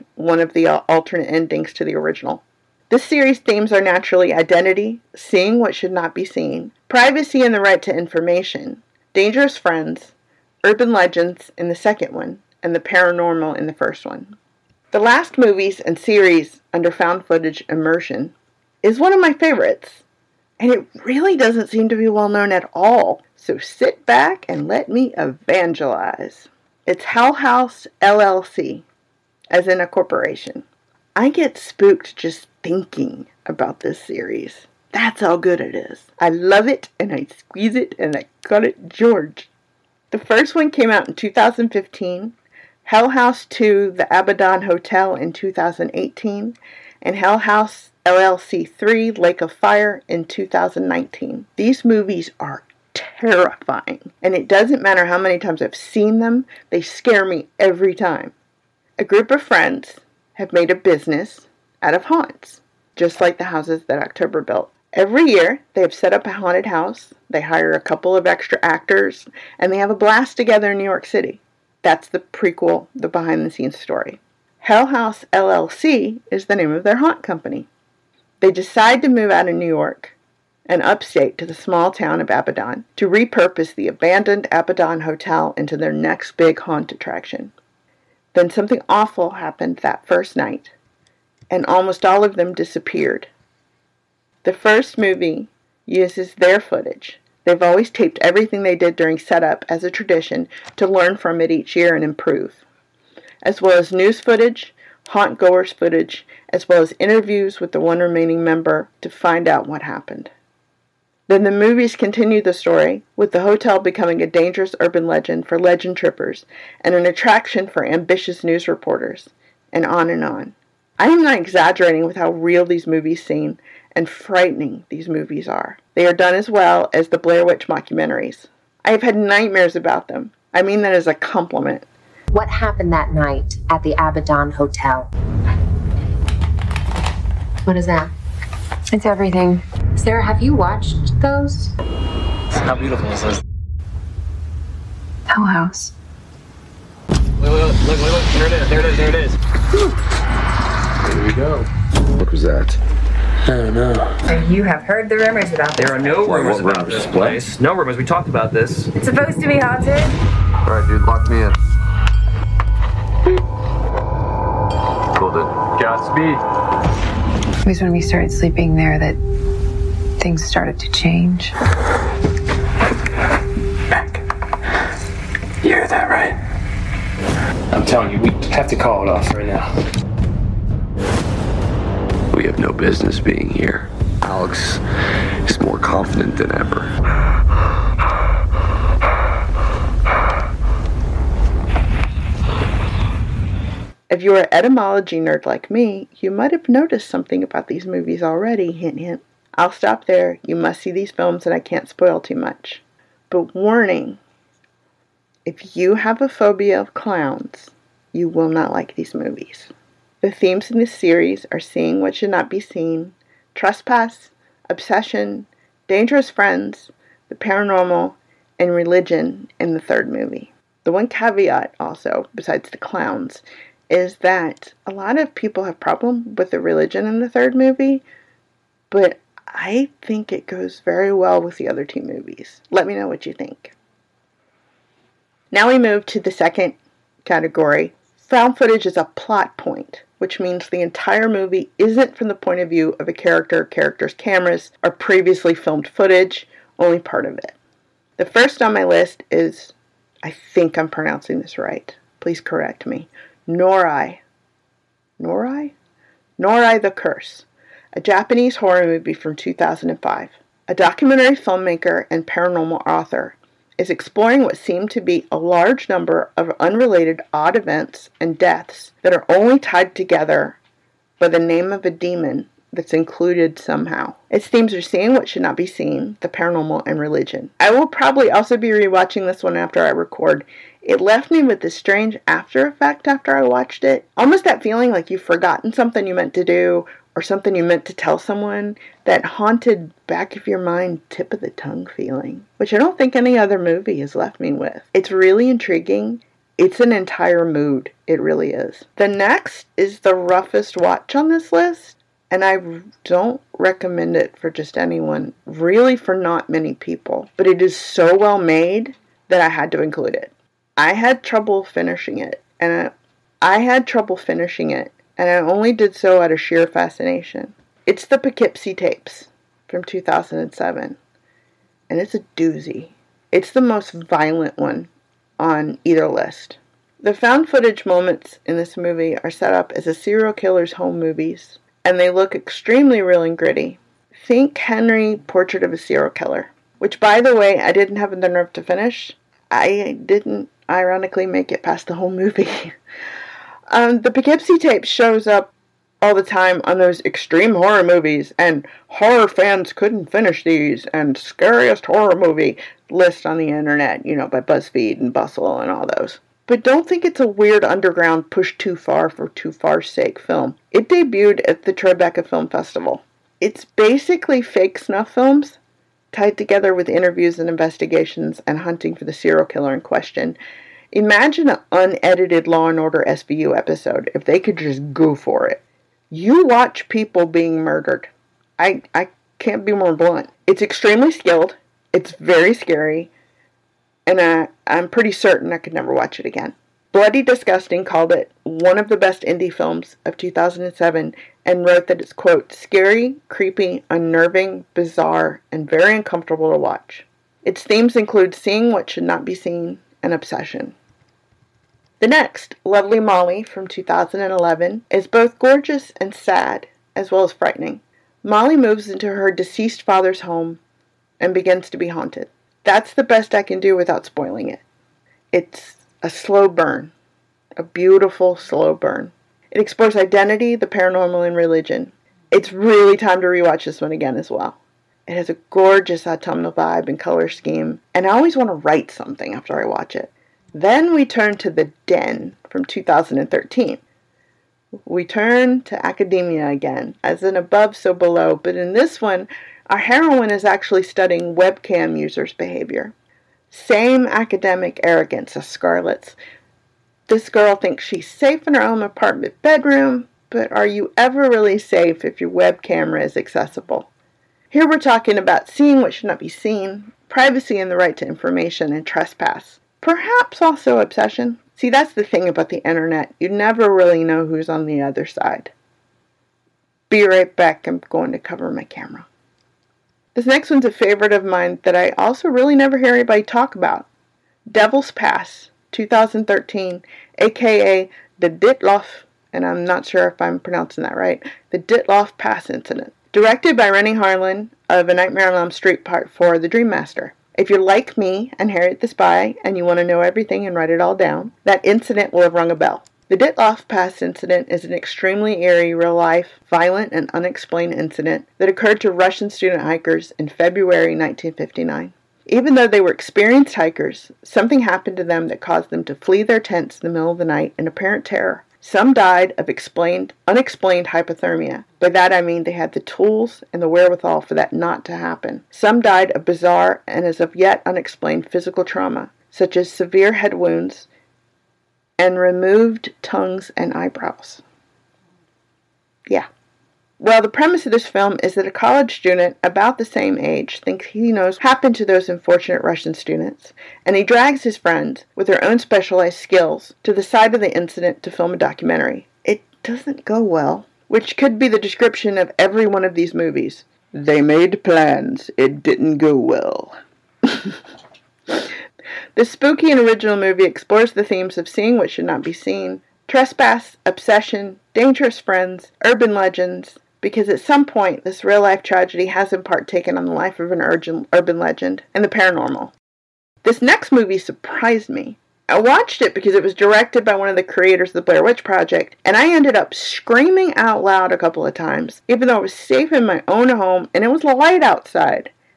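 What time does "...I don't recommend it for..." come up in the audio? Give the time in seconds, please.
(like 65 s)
302 s.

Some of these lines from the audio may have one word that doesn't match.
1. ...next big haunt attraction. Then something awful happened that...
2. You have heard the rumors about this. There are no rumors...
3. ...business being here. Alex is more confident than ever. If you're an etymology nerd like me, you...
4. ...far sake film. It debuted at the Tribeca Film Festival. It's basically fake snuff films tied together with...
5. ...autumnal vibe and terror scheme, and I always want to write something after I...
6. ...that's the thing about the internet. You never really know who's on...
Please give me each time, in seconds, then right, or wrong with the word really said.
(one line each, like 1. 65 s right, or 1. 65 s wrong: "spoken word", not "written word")
1. 85 s right
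2. 154 s right
3. 182 s right
4. 359 s right
5. 426 s wrong: "color", not "terror"
6. 461 s right.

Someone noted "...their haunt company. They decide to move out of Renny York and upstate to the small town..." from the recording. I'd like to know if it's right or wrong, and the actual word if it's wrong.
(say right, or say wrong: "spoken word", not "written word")
wrong: "New", not "Renny".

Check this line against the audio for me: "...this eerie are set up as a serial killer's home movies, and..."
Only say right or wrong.
wrong.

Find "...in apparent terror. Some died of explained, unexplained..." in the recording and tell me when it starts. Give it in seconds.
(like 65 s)
507 s.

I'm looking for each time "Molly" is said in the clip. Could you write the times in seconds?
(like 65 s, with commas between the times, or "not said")
402 s, 408 s.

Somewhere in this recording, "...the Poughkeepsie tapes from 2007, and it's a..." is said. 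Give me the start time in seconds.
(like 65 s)
318 s.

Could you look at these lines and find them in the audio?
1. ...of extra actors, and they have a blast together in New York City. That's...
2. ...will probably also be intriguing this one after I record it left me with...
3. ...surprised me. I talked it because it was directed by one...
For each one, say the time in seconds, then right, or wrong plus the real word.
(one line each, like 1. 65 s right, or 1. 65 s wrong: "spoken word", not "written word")
1. 68 s right
2. 277 s wrong: "rewatching", not "intriguing"
3. 564 s wrong: "watched", not "talked".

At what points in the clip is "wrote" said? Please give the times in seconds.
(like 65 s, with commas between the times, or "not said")
391 s.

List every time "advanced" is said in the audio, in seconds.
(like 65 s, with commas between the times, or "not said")
not said.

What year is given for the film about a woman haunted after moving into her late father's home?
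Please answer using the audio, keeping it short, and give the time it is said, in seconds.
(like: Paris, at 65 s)
2011, at 403 s.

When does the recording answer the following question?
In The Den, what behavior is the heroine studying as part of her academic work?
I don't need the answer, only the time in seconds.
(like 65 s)
441 s.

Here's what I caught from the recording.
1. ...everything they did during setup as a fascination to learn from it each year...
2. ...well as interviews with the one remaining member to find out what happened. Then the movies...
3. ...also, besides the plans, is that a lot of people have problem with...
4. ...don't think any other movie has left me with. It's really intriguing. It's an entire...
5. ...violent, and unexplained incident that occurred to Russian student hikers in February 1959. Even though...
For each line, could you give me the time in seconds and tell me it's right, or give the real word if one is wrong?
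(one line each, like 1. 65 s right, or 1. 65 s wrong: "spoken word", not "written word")
1. 98 s wrong: "tradition", not "fascination"
2. 106 s right
3. 221 s wrong: "clowns", not "plans"
4. 292 s right
5. 496 s right.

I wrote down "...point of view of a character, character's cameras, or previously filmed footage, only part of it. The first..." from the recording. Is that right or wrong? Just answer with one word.
right.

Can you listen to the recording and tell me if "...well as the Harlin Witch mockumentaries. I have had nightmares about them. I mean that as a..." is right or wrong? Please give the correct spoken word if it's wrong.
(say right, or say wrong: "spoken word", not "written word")
wrong: "Blair", not "Harlin".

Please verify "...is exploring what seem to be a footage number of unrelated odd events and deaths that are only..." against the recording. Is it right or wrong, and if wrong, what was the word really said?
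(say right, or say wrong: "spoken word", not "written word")
wrong: "large", not "footage".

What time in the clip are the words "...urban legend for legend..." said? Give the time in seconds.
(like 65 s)
114 s.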